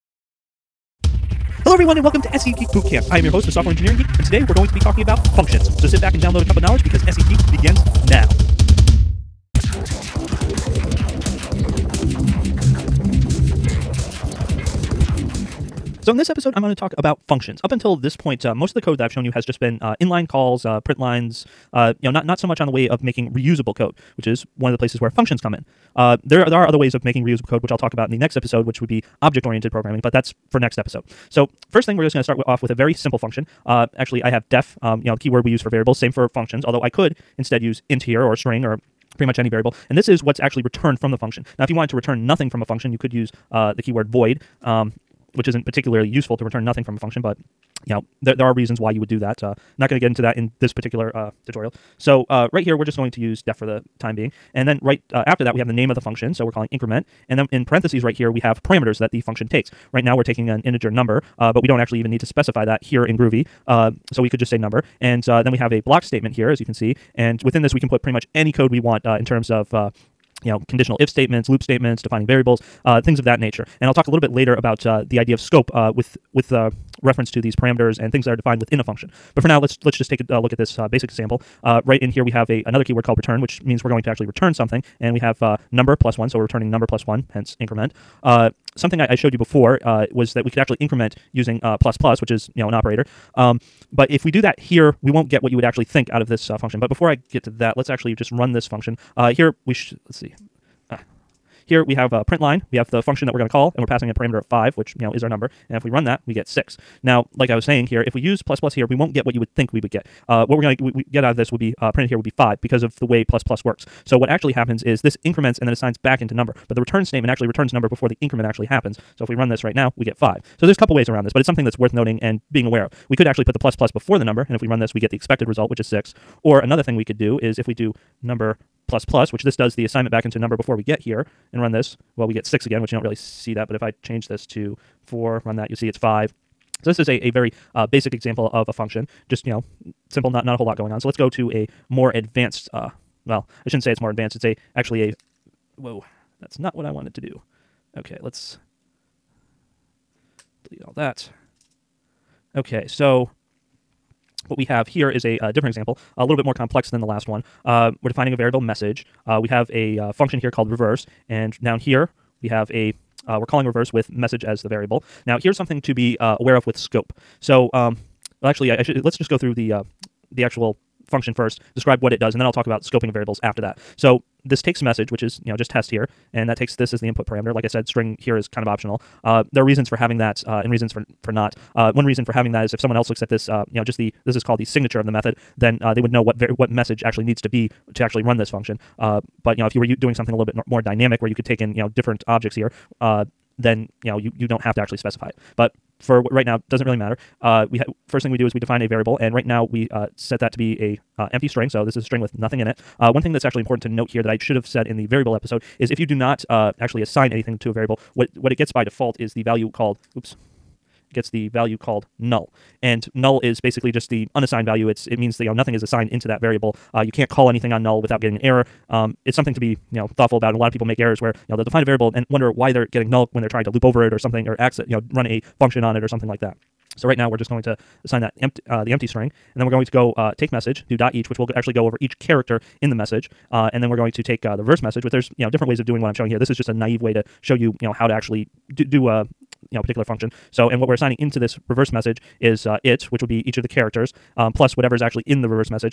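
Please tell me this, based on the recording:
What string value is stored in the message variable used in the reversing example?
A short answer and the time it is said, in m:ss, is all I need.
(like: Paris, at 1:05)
test, at 2:55.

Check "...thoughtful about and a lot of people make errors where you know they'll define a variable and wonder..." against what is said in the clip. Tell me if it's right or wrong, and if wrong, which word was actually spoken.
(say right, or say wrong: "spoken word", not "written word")
right.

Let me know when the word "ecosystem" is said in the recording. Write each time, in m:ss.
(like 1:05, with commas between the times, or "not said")
not said.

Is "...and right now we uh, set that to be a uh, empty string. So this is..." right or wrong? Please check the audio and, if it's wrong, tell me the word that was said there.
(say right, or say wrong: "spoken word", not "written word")
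right.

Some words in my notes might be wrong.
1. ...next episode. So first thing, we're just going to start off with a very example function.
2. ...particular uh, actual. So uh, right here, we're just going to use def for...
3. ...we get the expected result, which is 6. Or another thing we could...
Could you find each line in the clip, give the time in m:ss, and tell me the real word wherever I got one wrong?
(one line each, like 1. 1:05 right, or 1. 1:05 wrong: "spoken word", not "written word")
1. 0:30 wrong: "simple", not "example"
2. 0:50 wrong: "tutorial", not "actual"
3. 2:04 right.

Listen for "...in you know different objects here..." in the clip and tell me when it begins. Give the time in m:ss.
3:11.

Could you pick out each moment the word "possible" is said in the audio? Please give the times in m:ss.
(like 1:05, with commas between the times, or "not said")
not said.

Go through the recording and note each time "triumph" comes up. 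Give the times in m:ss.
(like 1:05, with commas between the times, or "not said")
not said.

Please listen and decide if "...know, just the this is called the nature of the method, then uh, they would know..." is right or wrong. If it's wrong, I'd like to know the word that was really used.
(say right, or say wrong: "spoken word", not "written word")
wrong: "signature", not "nature".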